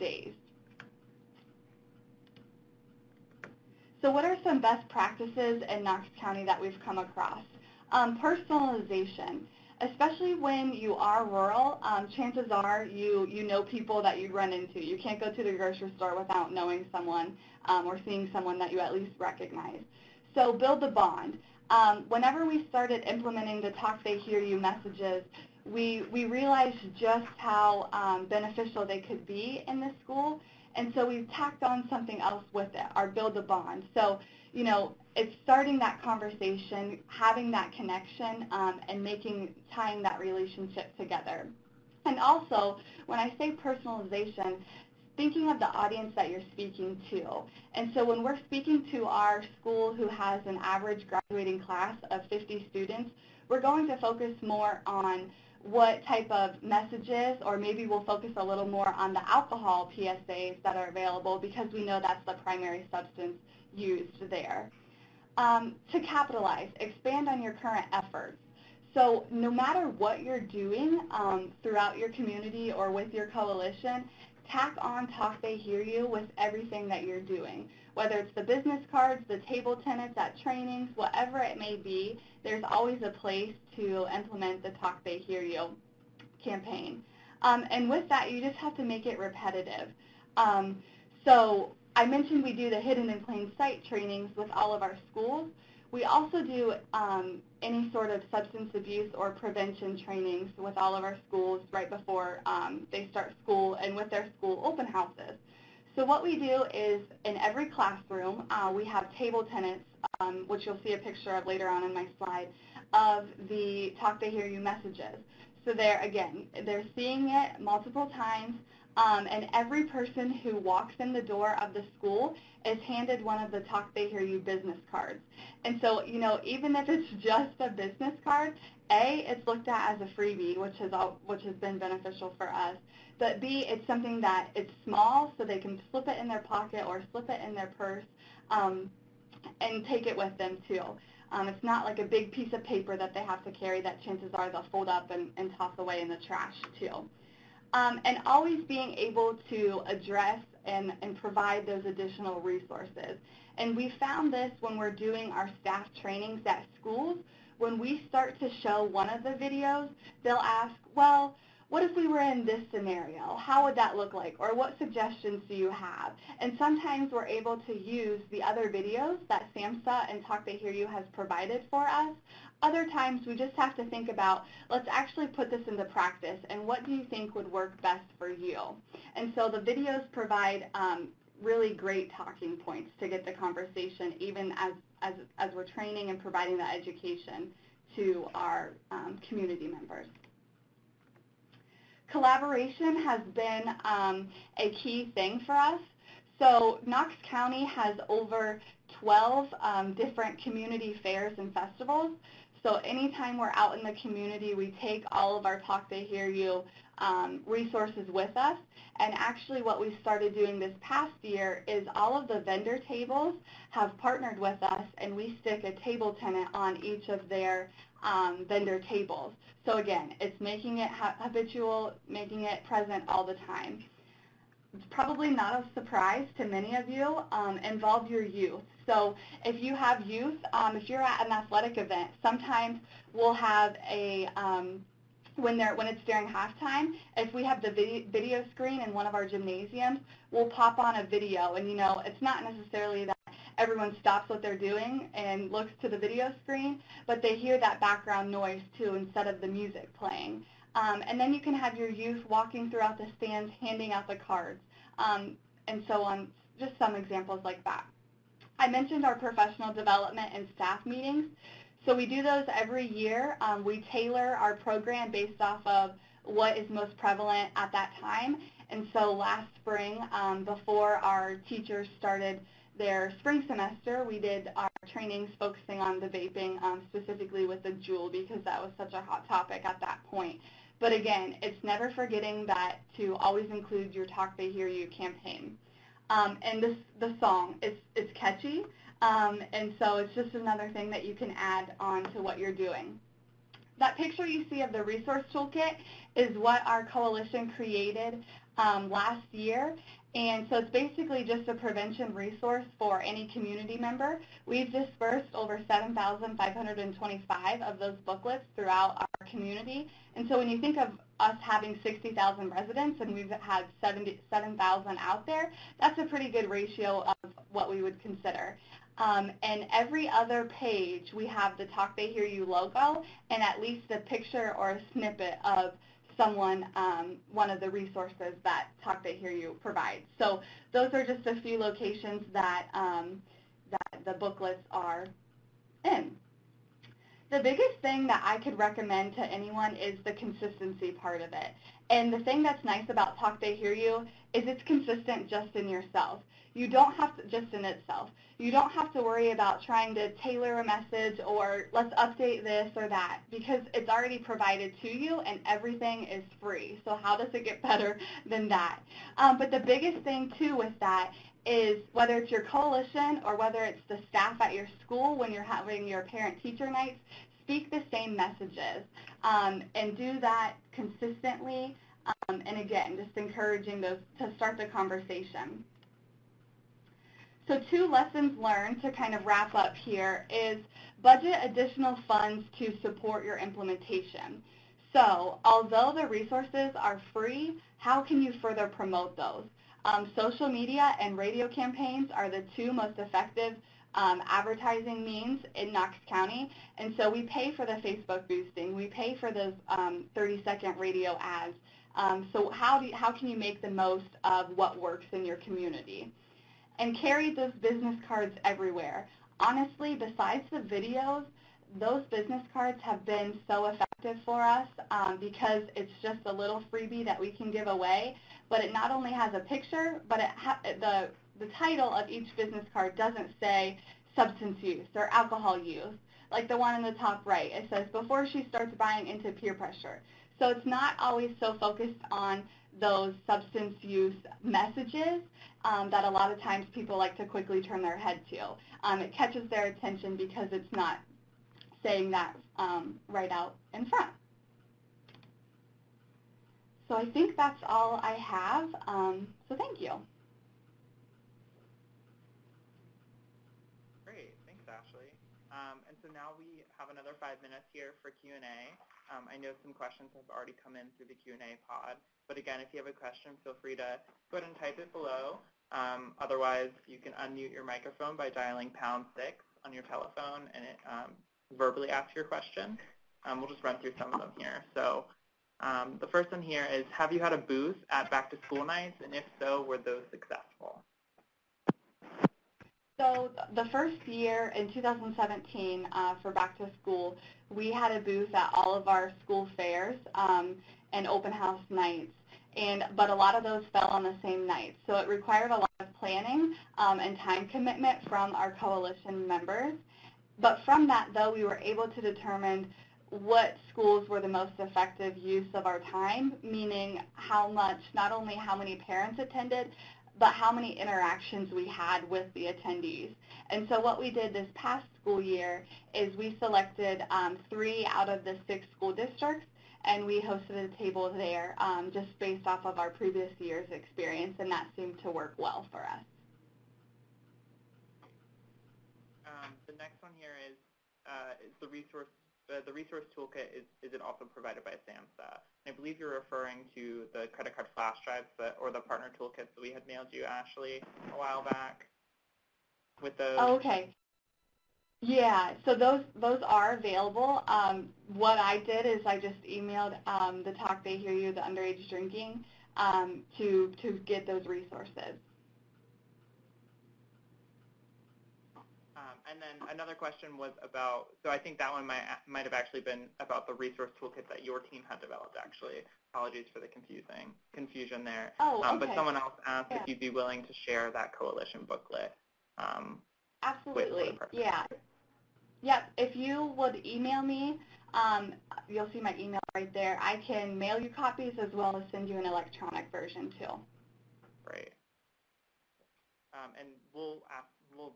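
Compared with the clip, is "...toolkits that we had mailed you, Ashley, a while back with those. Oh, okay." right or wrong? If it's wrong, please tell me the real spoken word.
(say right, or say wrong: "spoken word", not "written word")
right.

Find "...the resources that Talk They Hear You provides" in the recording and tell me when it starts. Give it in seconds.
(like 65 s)
327 s.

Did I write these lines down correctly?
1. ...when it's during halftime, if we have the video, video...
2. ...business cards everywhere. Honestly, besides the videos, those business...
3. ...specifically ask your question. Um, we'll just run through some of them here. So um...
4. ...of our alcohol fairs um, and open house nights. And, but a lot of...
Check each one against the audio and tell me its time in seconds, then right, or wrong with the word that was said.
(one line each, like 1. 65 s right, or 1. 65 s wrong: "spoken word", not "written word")
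1. 235 s right
2. 407 s right
3. 471 s wrong: "verbally", not "specifically"
4. 488 s wrong: "school", not "alcohol".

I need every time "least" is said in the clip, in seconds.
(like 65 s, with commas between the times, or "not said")
18 s, 323 s.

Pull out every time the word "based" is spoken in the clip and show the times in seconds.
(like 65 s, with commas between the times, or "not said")
265 s, 522 s.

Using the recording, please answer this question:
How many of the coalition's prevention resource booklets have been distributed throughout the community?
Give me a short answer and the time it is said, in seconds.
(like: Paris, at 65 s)
7,525, at 305 s.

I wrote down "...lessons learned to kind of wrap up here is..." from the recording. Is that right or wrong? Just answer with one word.
right.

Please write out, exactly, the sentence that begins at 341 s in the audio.
And the thing that's nice about Talk They Hear You is it's consistent just in yourself.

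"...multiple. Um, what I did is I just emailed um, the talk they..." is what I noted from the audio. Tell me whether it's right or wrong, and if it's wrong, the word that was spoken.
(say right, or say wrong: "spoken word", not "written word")
wrong: "available", not "multiple".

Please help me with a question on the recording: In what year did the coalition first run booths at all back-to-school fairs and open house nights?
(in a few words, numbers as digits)
2017.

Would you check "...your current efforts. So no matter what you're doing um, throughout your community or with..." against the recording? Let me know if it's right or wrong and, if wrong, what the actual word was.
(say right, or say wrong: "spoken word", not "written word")
right.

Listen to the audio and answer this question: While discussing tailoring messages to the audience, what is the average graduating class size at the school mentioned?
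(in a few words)
50 students.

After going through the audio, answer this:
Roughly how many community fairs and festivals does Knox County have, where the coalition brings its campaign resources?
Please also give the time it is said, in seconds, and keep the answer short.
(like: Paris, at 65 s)
over 12, at 198 s.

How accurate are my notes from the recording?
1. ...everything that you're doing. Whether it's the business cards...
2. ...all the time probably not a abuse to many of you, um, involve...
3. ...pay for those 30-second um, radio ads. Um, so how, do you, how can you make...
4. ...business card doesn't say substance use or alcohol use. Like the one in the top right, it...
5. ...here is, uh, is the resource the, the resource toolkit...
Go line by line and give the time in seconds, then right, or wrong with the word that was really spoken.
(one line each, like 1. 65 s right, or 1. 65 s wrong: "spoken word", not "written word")
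1. 76 s right
2. 223 s wrong: "surprise", not "abuse"
3. 398 s right
4. 422 s right
5. 530 s right.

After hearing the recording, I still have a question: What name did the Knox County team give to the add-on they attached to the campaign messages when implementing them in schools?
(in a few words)
Build a Bond.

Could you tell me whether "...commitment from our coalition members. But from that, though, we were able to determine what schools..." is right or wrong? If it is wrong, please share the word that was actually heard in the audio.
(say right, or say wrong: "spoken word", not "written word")
right.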